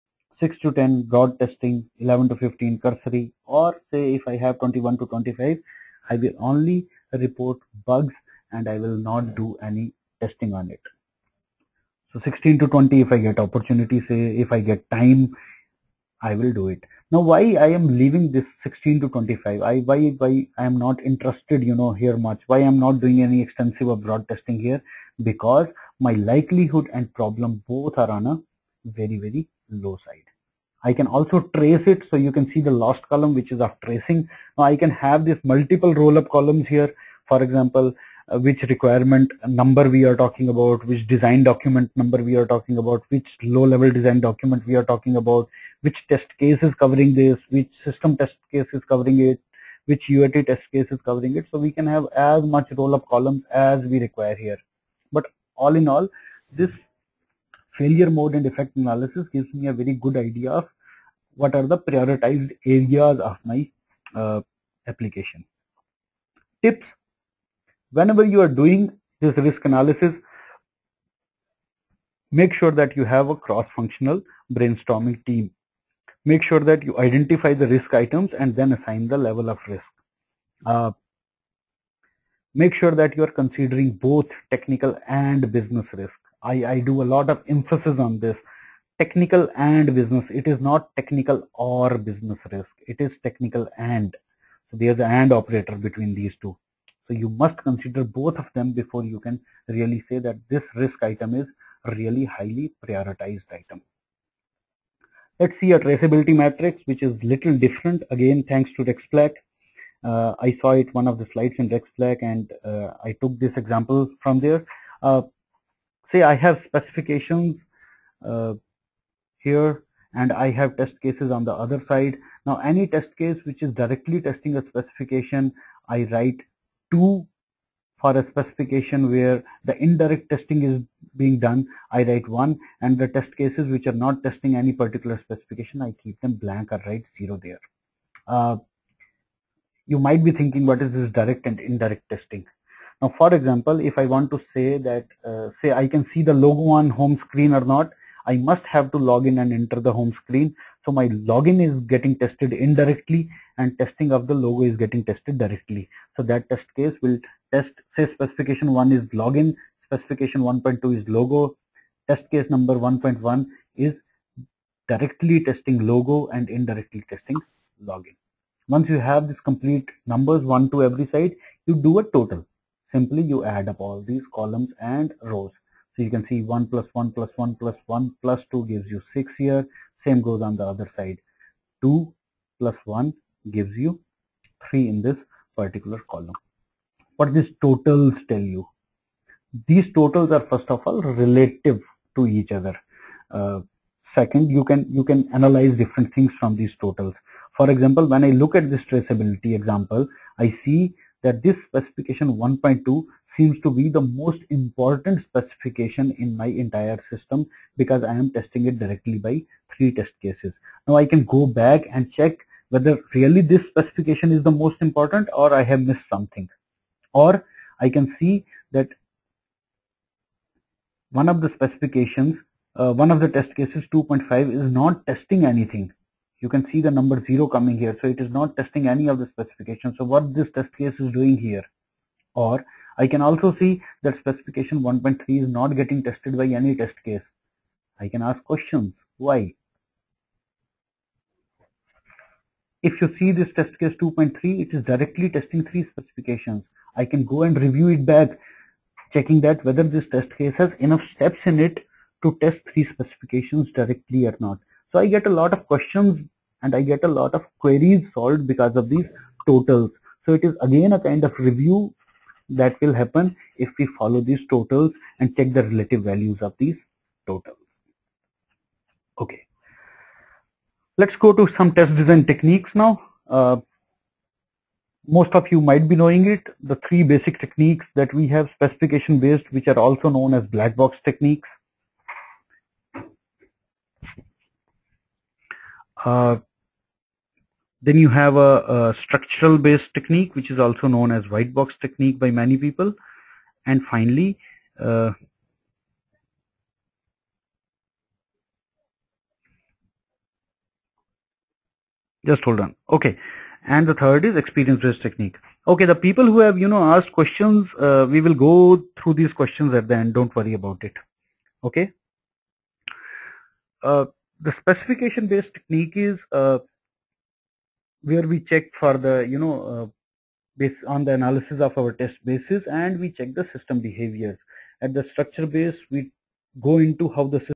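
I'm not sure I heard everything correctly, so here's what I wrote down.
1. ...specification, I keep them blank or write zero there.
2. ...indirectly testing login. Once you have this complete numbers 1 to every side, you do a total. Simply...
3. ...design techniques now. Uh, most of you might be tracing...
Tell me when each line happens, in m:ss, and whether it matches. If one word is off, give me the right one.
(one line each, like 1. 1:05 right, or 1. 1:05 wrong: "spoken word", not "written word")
1. 2:15 right
2. 2:46 right
3. 4:31 wrong: "knowing", not "tracing".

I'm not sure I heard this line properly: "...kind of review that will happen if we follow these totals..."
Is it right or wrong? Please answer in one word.
right.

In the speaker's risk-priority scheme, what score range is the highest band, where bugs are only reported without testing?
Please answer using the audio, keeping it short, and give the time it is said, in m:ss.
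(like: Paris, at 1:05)
21 to 25, at 0:04.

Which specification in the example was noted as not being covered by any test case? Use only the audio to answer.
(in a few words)
1.3.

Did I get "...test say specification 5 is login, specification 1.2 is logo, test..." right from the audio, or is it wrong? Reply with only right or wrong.
wrong.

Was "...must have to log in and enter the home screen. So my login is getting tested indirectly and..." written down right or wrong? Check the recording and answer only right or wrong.
right.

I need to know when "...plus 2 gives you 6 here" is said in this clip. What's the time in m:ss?
2:58.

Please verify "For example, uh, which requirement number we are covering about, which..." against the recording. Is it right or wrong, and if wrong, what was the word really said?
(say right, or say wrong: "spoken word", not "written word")
wrong: "talking", not "covering".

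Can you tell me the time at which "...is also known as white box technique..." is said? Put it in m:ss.
4:50.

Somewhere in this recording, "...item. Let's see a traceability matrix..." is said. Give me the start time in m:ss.
1:43.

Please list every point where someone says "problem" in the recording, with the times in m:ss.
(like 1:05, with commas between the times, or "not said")
0:27.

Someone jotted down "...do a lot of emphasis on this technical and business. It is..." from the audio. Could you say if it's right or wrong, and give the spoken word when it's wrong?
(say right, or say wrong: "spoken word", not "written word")
right.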